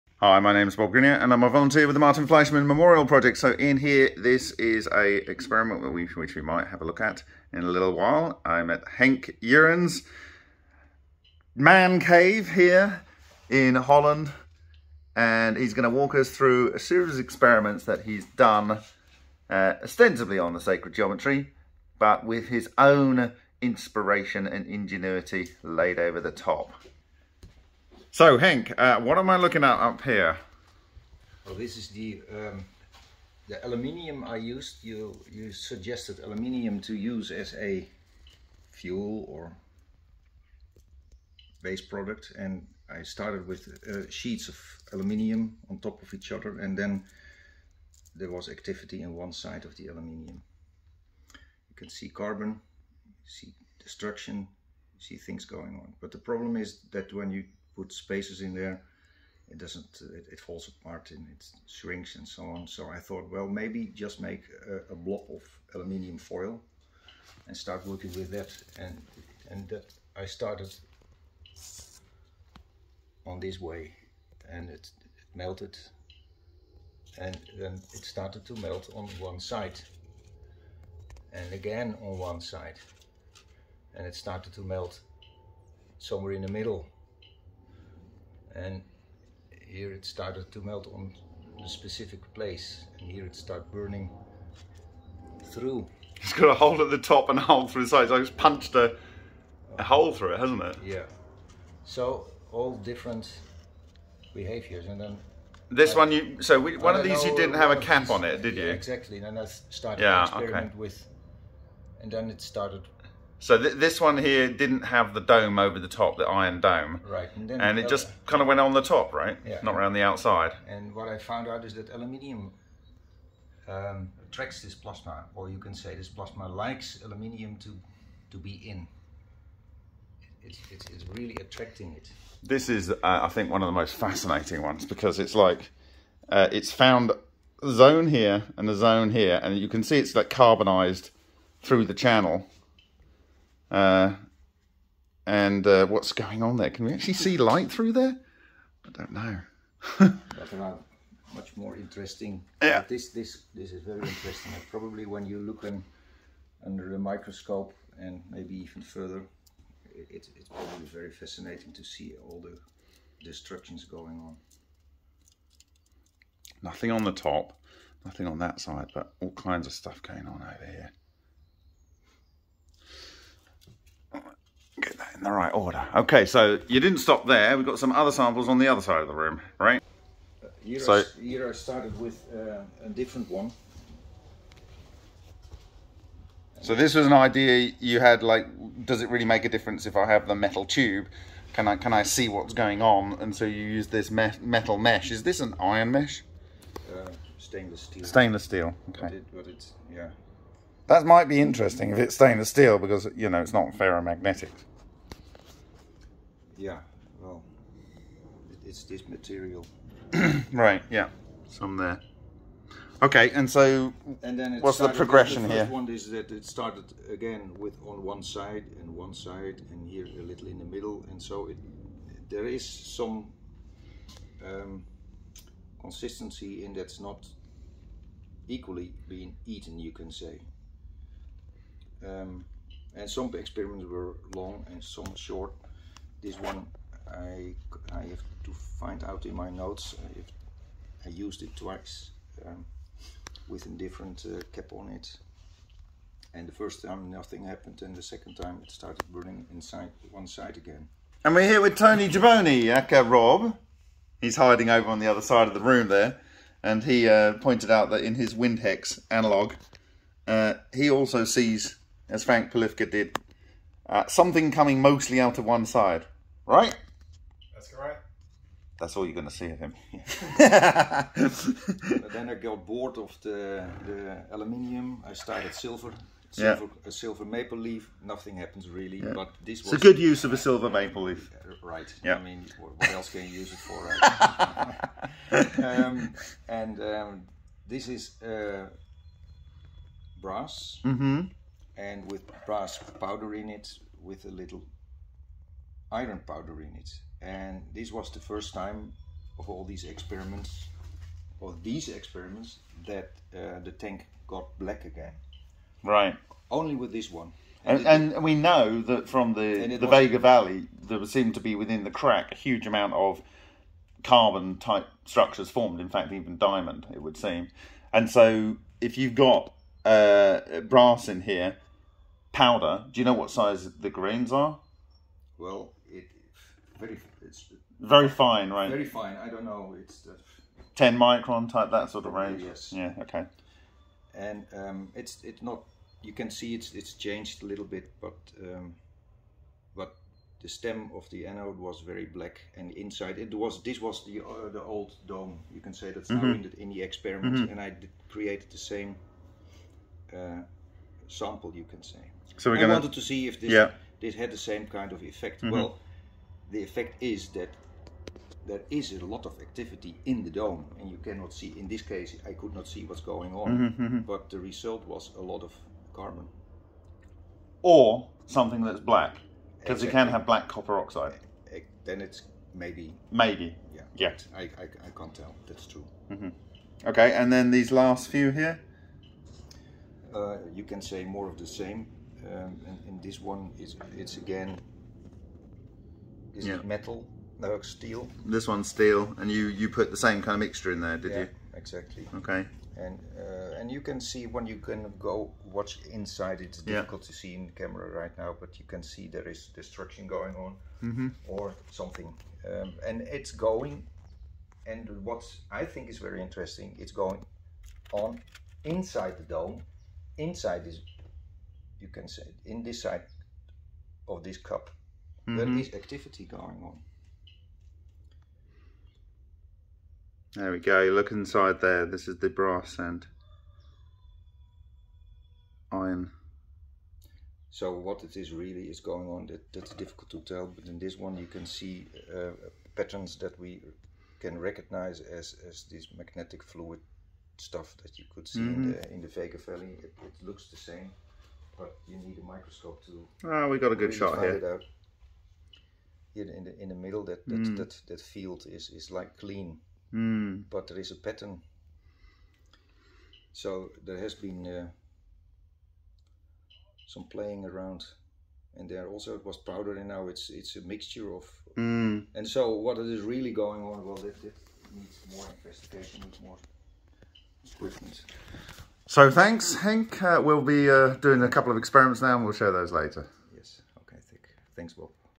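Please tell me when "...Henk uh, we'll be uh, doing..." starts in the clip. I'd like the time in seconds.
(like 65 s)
469 s.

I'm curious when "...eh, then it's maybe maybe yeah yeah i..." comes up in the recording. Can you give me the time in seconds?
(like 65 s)
371 s.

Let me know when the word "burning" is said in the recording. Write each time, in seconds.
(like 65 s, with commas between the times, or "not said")
93 s, 249 s.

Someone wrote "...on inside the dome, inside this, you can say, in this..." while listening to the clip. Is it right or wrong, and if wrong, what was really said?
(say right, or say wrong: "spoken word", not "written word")
right.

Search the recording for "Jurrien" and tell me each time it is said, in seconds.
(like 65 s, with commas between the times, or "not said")
9 s.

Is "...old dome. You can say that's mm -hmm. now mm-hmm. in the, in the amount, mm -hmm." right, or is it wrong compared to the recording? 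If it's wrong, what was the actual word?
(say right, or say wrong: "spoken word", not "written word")
wrong: "experiment", not "amount".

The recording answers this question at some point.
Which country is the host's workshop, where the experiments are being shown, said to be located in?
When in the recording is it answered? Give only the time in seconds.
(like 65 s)
13 s.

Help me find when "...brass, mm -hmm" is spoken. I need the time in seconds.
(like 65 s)
290 s.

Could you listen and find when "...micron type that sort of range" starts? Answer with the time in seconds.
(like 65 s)
330 s.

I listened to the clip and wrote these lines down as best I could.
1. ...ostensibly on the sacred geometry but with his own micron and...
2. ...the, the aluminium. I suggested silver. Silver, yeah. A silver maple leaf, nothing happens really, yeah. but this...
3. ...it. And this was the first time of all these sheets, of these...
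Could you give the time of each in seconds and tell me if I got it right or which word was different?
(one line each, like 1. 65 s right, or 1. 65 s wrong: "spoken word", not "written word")
1. 19 s wrong: "inspiration", not "micron"
2. 273 s wrong: "started", not "suggested"
3. 296 s wrong: "experiments", not "sheets".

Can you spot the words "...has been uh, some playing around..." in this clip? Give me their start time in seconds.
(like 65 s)
453 s.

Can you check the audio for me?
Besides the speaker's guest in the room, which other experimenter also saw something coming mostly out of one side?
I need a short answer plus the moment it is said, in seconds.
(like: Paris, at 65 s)
Frank Polifka, at 262 s.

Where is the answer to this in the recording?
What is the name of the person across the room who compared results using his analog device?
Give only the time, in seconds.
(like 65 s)
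253 s.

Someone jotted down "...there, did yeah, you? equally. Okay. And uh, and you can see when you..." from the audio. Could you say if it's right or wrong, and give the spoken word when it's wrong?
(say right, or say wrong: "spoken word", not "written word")
wrong: "exactly", not "equally".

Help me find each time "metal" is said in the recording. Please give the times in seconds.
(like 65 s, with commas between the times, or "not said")
190 s, 194 s, 386 s.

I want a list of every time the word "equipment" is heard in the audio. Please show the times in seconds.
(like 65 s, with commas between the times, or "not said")
467 s.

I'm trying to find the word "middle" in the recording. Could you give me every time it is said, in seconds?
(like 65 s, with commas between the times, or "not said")
86 s, 220 s, 446 s.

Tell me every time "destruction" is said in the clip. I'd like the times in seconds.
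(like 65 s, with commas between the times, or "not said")
53 s, 163 s, 399 s.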